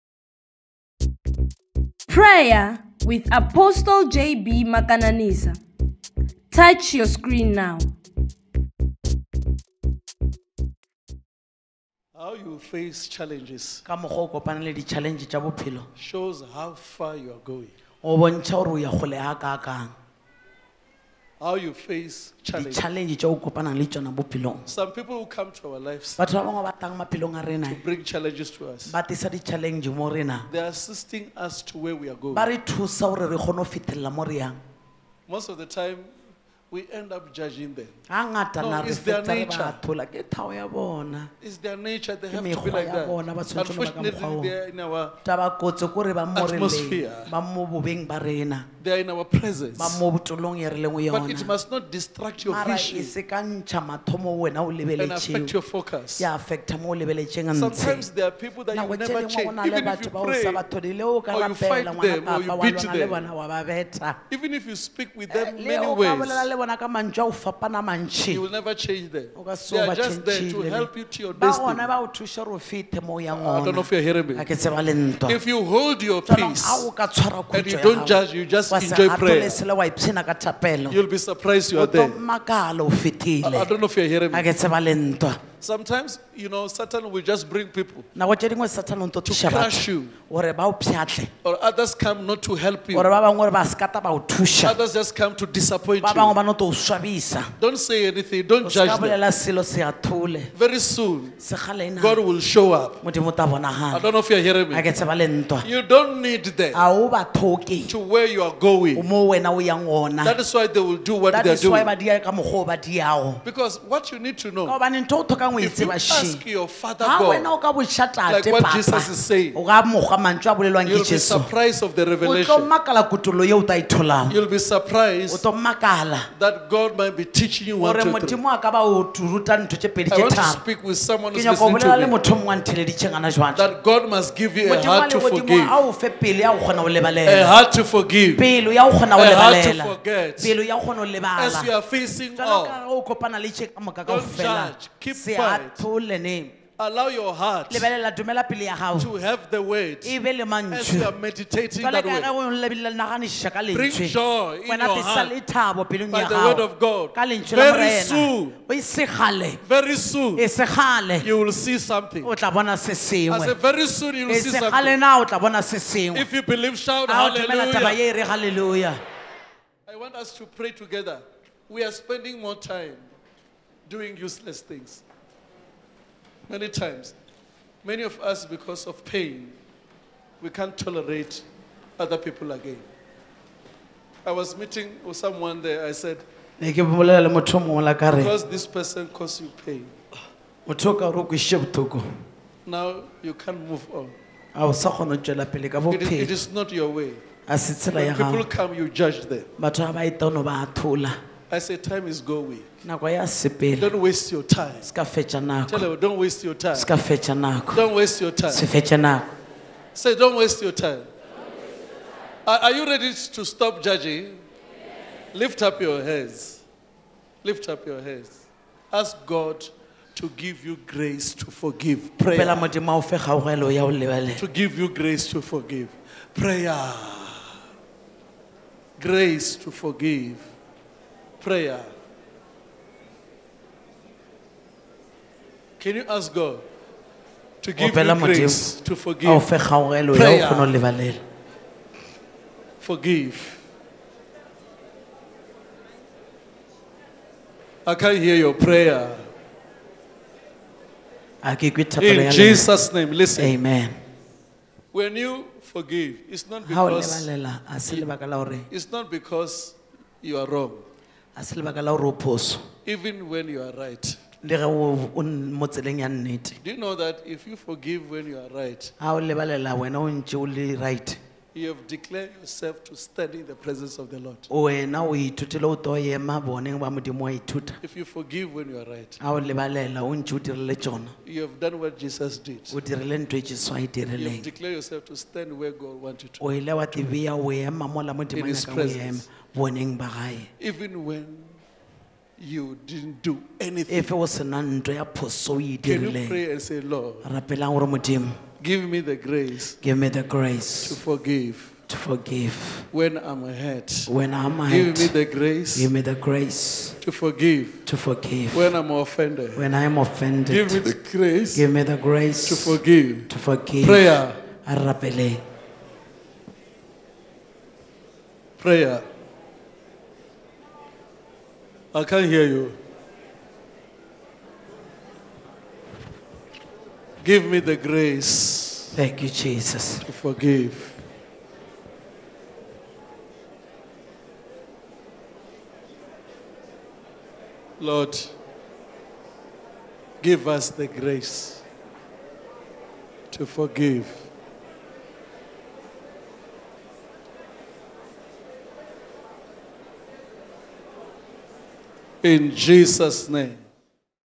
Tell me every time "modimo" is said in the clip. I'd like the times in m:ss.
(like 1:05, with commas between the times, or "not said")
2:08, 4:57.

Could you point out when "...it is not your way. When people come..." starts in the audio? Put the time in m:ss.
3:16.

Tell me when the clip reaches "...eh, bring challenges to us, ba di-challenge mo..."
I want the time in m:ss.
0:27.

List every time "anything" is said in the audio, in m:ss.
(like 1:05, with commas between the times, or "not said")
1:38, 4:53.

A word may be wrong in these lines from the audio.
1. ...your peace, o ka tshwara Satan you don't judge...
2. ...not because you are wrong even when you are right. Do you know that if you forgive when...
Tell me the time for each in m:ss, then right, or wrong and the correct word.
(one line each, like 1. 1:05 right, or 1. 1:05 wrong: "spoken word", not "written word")
1. 1:16 wrong: "And", not "Satan"
2. 4:18 right.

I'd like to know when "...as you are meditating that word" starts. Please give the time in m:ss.
2:30.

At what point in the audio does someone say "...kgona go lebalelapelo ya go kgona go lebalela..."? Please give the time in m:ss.
2:16.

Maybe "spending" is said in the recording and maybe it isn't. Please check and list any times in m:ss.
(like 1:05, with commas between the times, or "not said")
2:51.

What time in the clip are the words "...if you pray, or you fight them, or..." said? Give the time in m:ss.
0:59.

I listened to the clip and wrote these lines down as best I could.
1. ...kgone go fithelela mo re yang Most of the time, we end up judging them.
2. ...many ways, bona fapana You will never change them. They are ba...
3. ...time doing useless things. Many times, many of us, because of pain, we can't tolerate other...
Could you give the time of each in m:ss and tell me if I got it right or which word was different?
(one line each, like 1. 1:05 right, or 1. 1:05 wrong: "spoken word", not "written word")
1. 0:33 right
2. 1:05 right
3. 2:52 right.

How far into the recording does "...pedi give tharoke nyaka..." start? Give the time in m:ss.
2:09.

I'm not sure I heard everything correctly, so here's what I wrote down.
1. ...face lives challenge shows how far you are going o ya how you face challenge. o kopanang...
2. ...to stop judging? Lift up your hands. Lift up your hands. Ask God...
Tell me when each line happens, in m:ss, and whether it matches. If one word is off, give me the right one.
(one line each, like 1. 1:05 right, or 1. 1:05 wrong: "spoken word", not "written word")
1. 0:12 wrong: "challenges", not "lives"
2. 3:33 right.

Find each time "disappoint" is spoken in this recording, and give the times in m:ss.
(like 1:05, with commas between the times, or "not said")
1:35.